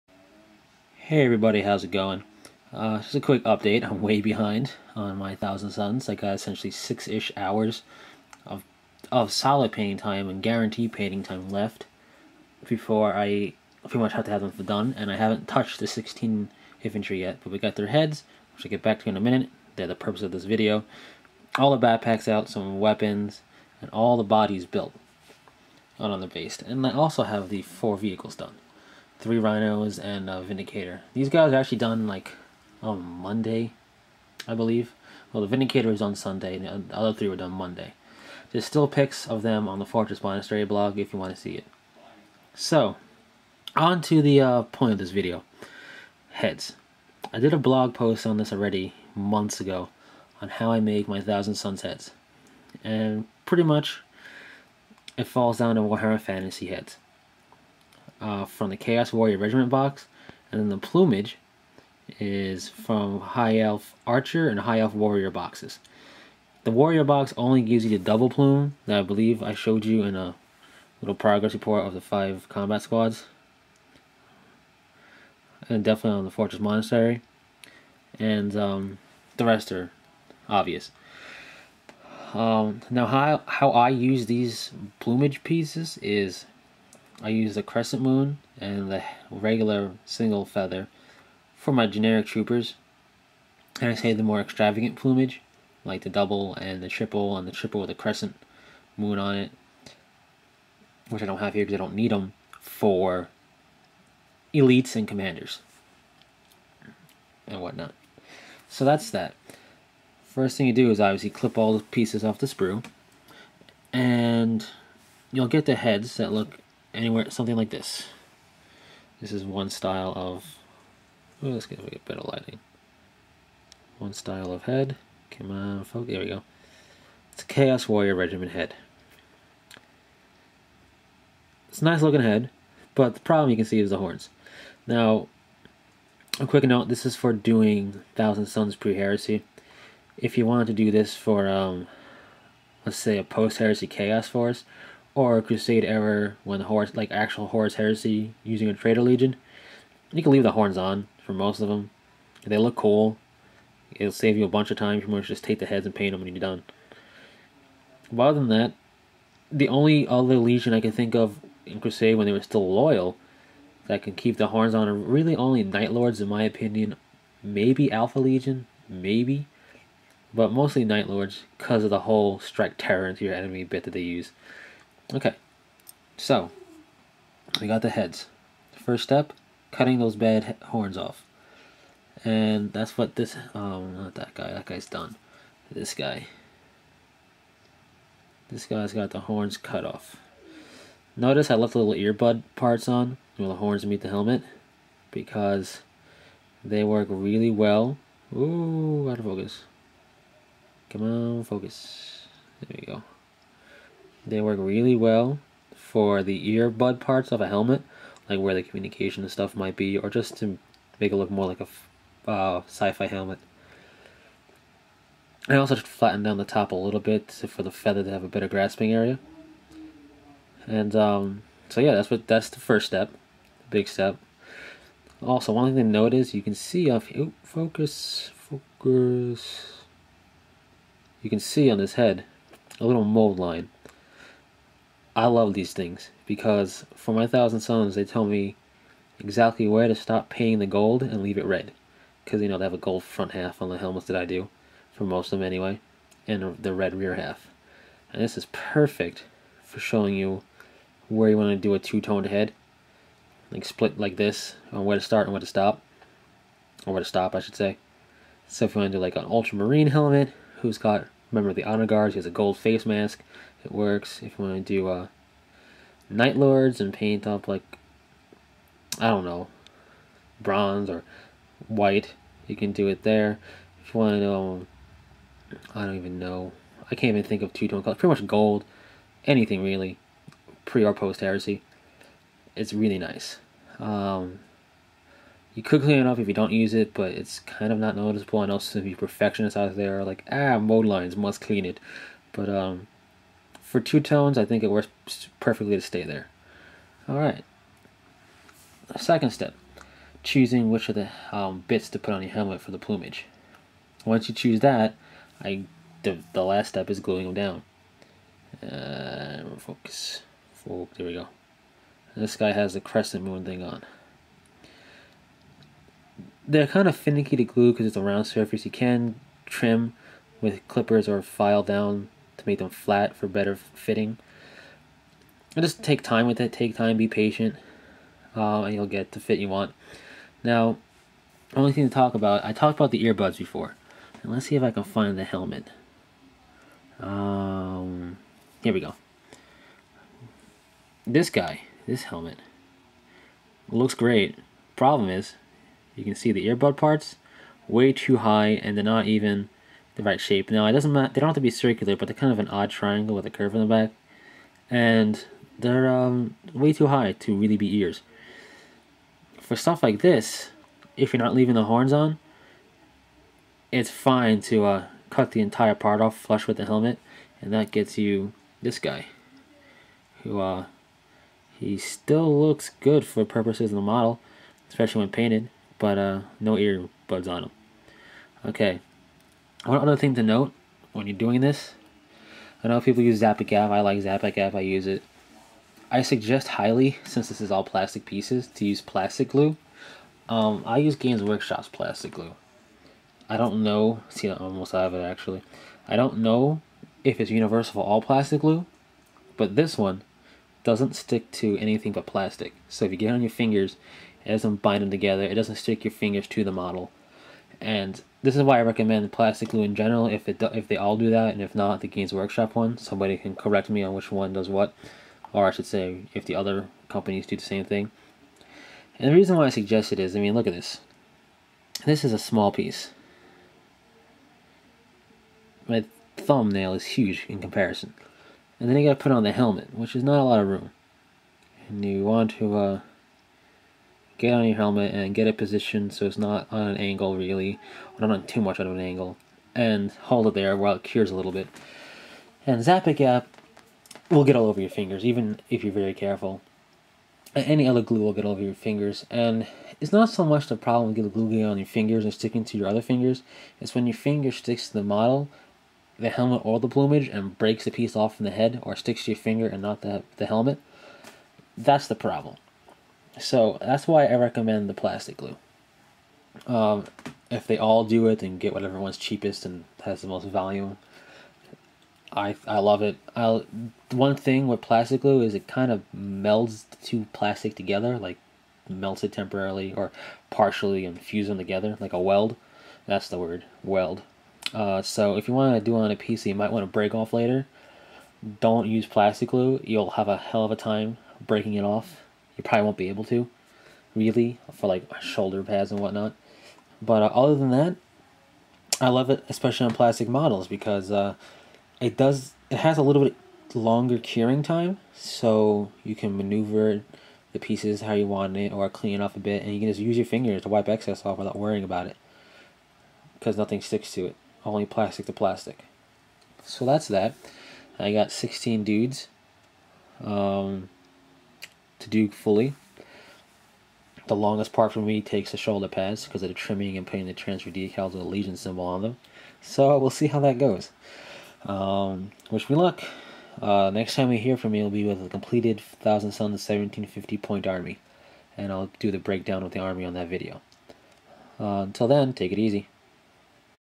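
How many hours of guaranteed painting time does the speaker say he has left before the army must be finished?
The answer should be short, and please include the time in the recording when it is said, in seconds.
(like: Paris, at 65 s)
6, at 6 s.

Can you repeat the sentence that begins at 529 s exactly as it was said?
So we'll see how that goes.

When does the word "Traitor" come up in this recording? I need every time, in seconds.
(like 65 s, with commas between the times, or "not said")
148 s.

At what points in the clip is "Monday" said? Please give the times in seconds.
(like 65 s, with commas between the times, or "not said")
33 s, 37 s.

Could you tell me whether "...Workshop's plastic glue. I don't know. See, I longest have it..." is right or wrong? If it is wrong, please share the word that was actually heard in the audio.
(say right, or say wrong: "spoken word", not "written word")
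wrong: "almost", not "longest".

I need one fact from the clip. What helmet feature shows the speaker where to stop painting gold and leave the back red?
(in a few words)
mold line.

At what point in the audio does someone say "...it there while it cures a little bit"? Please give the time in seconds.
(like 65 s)
440 s.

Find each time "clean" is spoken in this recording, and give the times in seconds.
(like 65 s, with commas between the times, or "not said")
285 s, 291 s, 508 s.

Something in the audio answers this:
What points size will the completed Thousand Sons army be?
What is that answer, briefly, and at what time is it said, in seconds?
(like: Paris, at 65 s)
1750, at 536 s.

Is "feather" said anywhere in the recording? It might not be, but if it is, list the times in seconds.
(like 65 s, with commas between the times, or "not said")
90 s, 217 s.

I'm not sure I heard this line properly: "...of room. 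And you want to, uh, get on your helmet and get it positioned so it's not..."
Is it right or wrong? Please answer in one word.
right.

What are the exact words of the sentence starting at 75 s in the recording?
And definitely on the Fortress Monastery.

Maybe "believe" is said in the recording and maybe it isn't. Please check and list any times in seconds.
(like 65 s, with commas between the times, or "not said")
34 s, 69 s.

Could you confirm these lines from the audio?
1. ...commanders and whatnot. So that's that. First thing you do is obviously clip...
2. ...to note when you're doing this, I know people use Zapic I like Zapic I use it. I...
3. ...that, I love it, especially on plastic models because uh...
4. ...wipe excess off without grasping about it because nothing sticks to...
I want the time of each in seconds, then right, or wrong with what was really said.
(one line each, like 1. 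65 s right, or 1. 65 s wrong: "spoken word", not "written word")
1. 105 s right
2. 380 s right
3. 497 s right
4. 510 s wrong: "worrying", not "grasping".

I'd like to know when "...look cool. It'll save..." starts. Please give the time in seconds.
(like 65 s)
152 s.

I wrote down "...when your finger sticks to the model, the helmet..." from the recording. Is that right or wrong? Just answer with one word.
right.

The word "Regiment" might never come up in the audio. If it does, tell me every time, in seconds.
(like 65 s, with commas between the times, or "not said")
59 s, 128 s.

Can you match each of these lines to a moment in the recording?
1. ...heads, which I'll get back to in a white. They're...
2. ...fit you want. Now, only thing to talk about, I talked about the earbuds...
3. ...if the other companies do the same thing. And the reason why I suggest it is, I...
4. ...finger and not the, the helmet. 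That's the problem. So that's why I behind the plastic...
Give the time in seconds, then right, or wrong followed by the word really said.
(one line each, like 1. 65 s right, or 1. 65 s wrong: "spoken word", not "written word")
1. 17 s wrong: "minute", not "white"
2. 329 s right
3. 416 s right
4. 459 s wrong: "recommend", not "behind".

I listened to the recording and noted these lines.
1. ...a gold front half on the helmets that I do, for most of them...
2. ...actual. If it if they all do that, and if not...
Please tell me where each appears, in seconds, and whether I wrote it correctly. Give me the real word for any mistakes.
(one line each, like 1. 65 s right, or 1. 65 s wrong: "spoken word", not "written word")
1. 242 s right
2. 409 s wrong: "general", not "actual".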